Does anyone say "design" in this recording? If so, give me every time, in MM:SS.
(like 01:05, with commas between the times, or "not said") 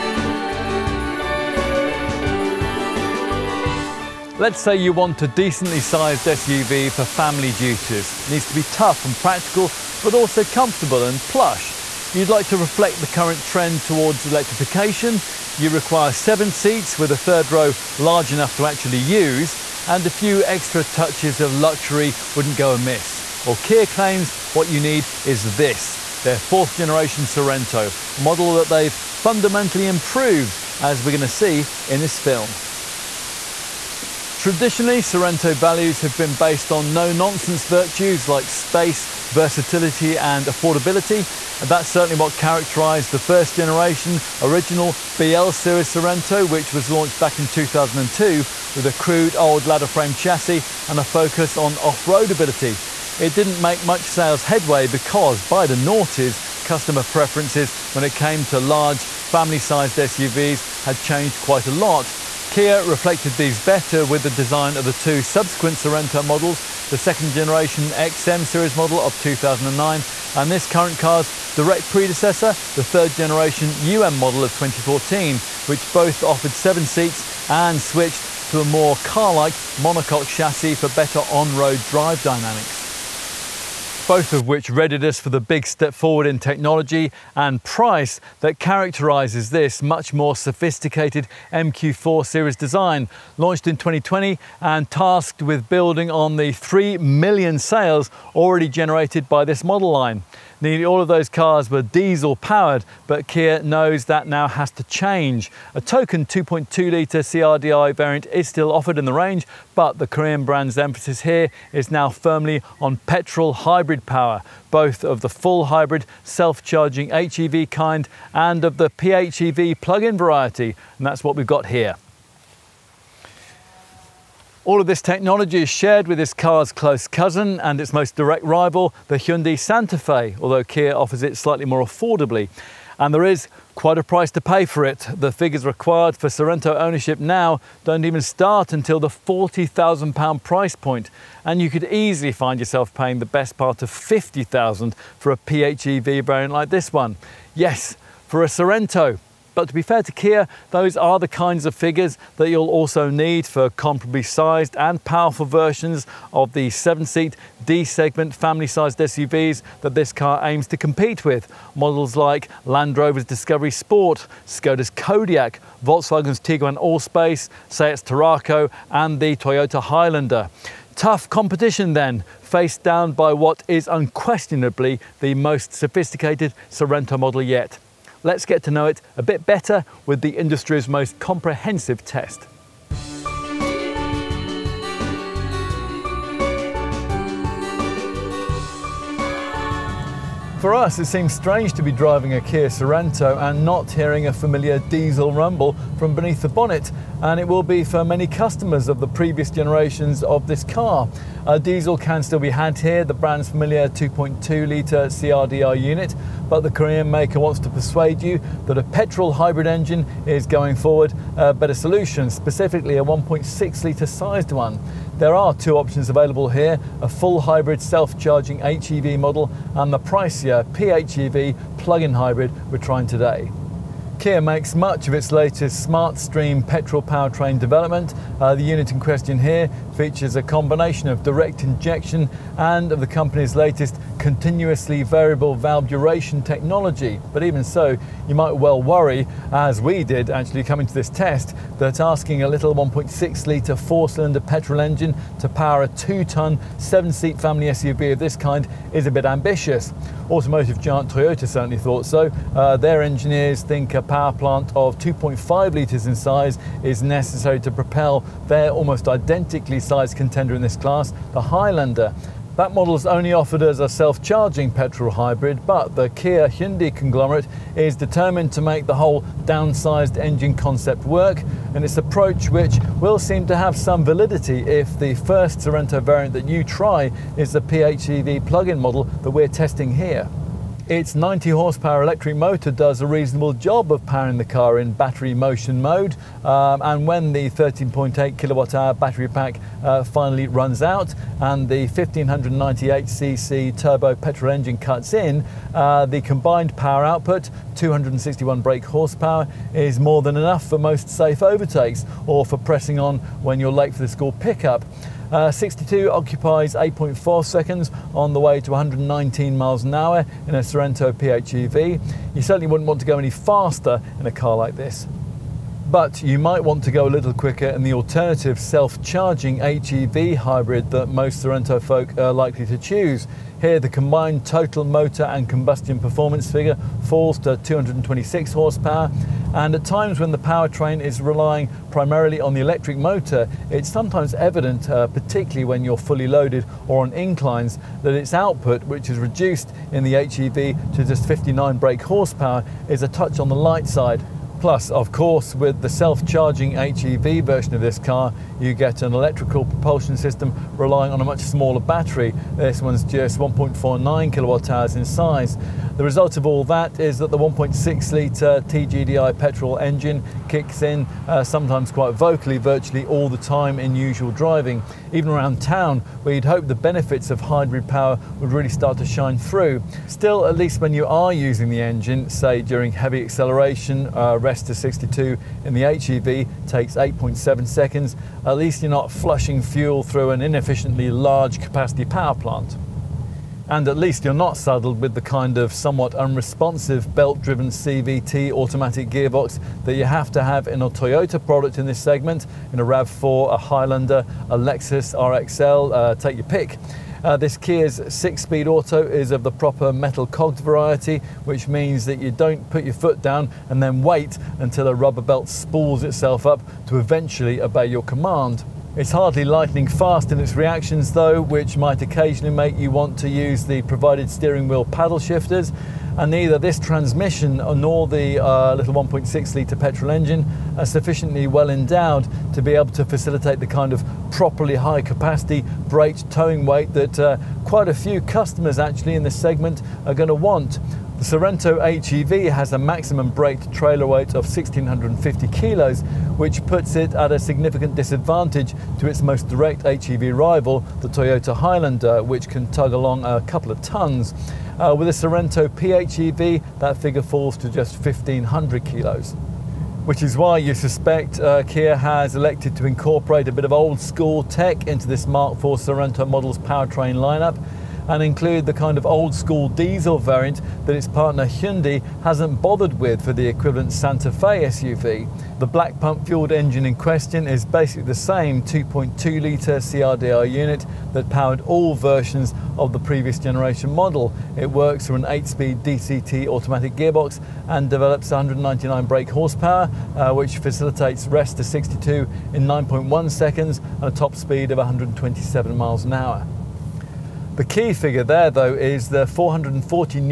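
01:04, 01:32.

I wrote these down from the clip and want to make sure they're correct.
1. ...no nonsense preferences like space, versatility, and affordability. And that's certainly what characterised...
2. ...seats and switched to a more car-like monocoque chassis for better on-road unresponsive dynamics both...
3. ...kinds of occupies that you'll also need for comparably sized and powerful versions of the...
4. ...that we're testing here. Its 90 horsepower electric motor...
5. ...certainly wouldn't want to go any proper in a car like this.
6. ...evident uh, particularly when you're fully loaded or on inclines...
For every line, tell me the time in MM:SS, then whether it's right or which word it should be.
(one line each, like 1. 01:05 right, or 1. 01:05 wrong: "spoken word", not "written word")
1. 00:36 wrong: "virtues", not "preferences"
2. 01:16 wrong: "drive", not "unresponsive"
3. 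02:31 wrong: "figures", not "occupies"
4. 04:39 right
5. 05:12 wrong: "faster", not "proper"
6. 05:34 right.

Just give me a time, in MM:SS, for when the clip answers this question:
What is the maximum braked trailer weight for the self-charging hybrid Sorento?
07:14.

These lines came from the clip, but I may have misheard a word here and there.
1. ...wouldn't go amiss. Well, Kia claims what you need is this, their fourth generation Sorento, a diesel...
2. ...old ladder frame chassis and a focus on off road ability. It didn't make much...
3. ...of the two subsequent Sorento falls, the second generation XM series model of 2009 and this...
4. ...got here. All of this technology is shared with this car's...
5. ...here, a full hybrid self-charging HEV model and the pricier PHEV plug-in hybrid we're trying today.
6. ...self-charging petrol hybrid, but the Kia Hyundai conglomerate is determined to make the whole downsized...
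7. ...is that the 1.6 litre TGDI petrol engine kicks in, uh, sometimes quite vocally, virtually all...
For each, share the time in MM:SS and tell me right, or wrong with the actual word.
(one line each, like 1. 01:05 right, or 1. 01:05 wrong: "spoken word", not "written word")
1. 00:22 wrong: "model", not "diesel"
2. 00:49 right
3. 01:04 wrong: "models", not "falls"
4. 02:01 right
5. 03:36 right
6. 04:23 right
7. 05:57 right.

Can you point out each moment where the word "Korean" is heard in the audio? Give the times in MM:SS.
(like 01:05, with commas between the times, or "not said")
01:50, 03:26.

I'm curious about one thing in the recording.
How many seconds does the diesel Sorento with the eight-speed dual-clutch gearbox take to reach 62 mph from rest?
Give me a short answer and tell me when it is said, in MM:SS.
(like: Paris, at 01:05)
9.1 seconds, at 08:02.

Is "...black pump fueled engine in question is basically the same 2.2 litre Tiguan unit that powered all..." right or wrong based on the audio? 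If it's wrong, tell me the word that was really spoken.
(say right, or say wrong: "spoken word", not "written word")
wrong: "CRDI", not "Tiguan".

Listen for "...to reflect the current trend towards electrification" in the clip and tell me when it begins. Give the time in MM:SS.
00:12.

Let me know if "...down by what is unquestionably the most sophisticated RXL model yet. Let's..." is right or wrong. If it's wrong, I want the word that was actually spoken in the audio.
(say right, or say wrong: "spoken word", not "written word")
wrong: "Sorento", not "RXL".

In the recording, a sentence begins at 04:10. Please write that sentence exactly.
Automotive giant Toyota certainly thought so.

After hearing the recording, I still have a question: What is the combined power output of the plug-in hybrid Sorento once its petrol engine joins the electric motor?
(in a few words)
261 brake horsepower.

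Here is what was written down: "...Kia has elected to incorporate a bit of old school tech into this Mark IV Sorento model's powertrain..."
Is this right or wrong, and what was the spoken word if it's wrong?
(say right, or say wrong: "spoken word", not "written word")
right.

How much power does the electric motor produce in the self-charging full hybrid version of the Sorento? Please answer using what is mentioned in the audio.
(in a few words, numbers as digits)
59 brake horsepower.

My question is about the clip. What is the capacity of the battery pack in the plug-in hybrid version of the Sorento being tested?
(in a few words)
13.8 kilowatt hours.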